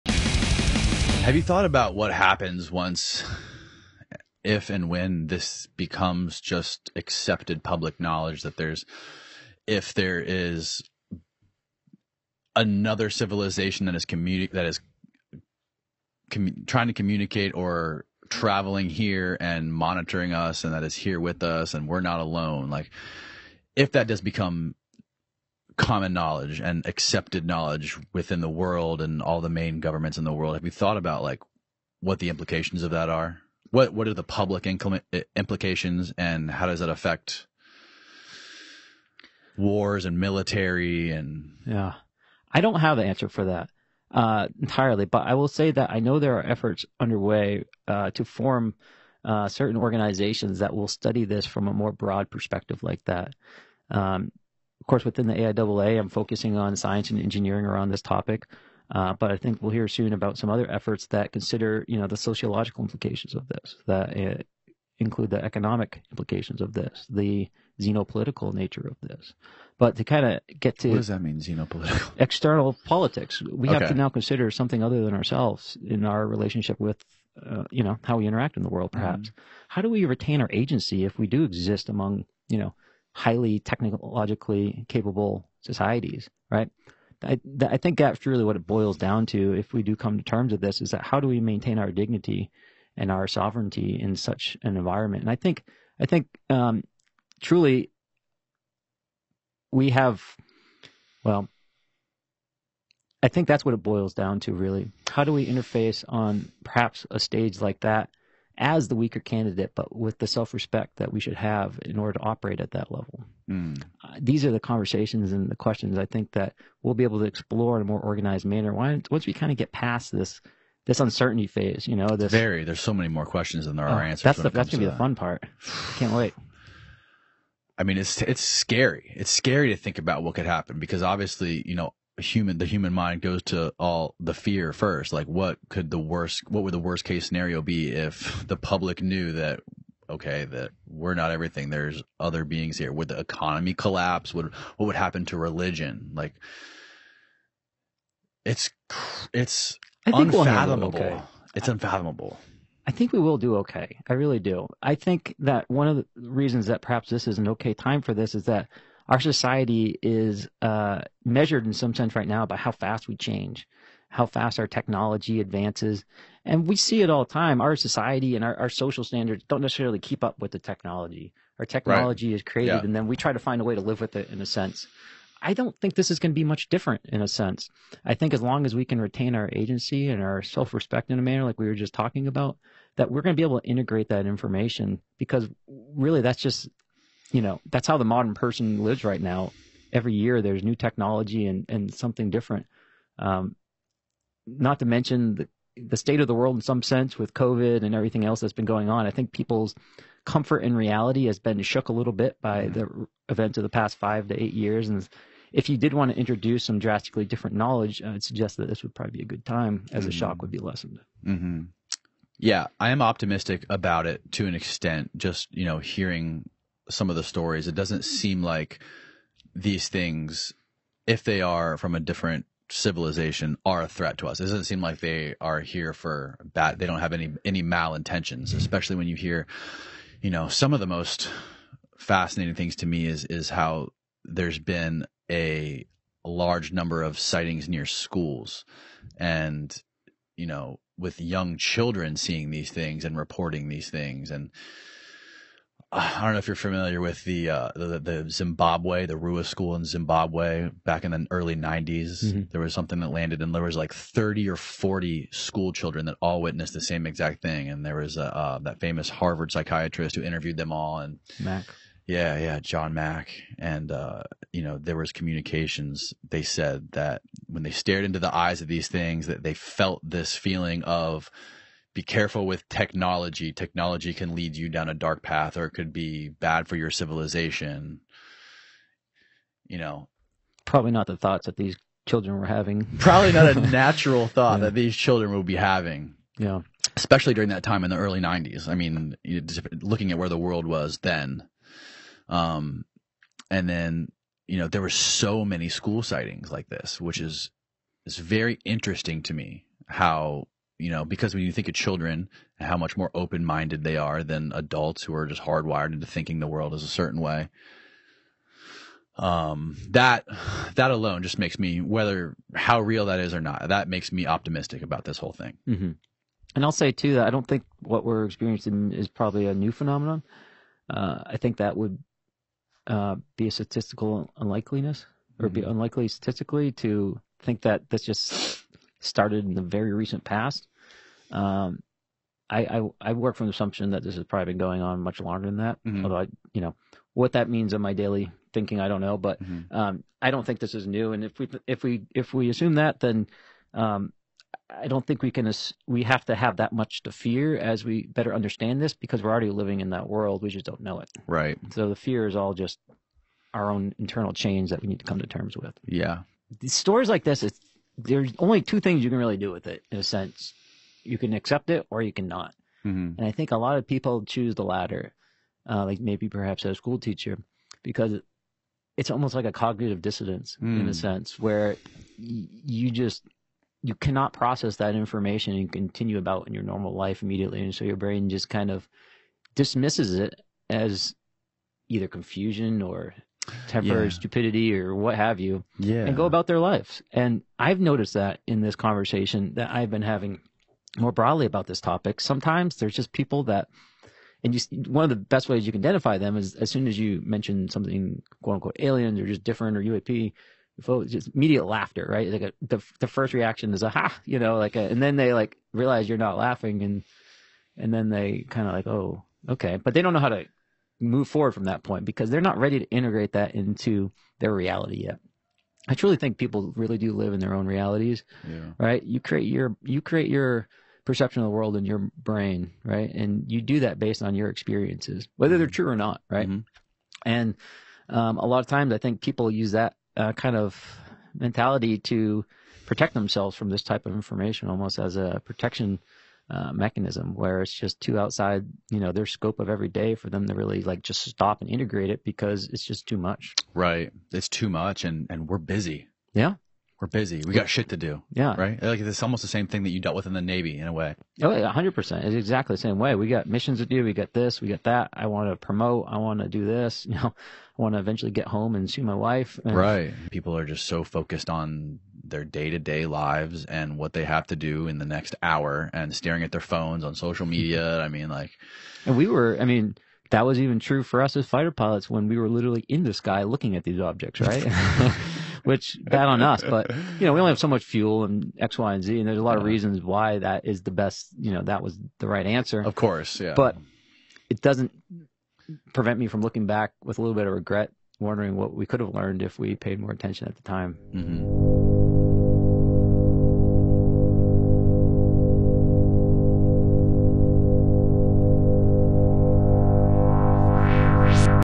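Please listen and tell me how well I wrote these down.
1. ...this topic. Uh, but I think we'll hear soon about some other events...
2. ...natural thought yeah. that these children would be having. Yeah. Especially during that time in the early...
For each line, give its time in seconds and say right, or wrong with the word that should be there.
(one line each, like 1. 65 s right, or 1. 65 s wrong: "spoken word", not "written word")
1. 57 s wrong: "efforts", not "events"
2. 283 s right.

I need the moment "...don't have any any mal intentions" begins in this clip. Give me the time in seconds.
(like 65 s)
226 s.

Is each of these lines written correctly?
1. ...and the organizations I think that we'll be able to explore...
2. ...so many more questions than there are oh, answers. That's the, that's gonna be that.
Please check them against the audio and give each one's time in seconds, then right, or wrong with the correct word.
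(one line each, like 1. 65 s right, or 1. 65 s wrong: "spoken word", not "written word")
1. 115 s wrong: "questions", not "organizations"
2. 122 s right.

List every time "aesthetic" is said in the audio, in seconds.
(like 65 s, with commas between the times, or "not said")
not said.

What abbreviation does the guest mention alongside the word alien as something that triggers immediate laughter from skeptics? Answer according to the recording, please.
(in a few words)
UAP.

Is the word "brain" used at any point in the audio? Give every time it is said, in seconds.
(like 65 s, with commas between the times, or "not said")
377 s, 422 s.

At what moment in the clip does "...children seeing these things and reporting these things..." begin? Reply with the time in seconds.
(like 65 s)
241 s.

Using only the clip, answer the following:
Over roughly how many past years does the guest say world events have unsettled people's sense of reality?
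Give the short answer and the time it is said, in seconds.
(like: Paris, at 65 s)
5 to 8 years, at 203 s.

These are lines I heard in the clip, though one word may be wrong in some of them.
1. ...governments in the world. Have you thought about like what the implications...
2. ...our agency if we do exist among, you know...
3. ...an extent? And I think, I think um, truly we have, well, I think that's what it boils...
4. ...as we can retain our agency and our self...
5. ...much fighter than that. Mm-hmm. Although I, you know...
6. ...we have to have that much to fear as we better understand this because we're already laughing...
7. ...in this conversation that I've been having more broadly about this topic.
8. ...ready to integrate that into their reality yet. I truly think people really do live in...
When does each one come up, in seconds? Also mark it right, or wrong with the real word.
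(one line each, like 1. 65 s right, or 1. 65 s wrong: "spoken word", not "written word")
1. 29 s right
2. 80 s right
3. 94 s wrong: "environment", not "extent"
4. 178 s right
5. 335 s wrong: "longer", not "fighter"
6. 345 s wrong: "living", not "laughing"
7. 388 s right
8. 412 s right.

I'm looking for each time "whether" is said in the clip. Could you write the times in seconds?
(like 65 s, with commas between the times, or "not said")
311 s, 425 s.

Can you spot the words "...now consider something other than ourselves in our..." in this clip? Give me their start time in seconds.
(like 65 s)
73 s.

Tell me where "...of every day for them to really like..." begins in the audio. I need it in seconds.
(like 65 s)
439 s.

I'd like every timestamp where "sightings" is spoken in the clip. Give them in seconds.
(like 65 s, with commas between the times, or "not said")
237 s, 296 s.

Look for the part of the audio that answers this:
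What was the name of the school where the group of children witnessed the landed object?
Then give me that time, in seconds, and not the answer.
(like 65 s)
249 s.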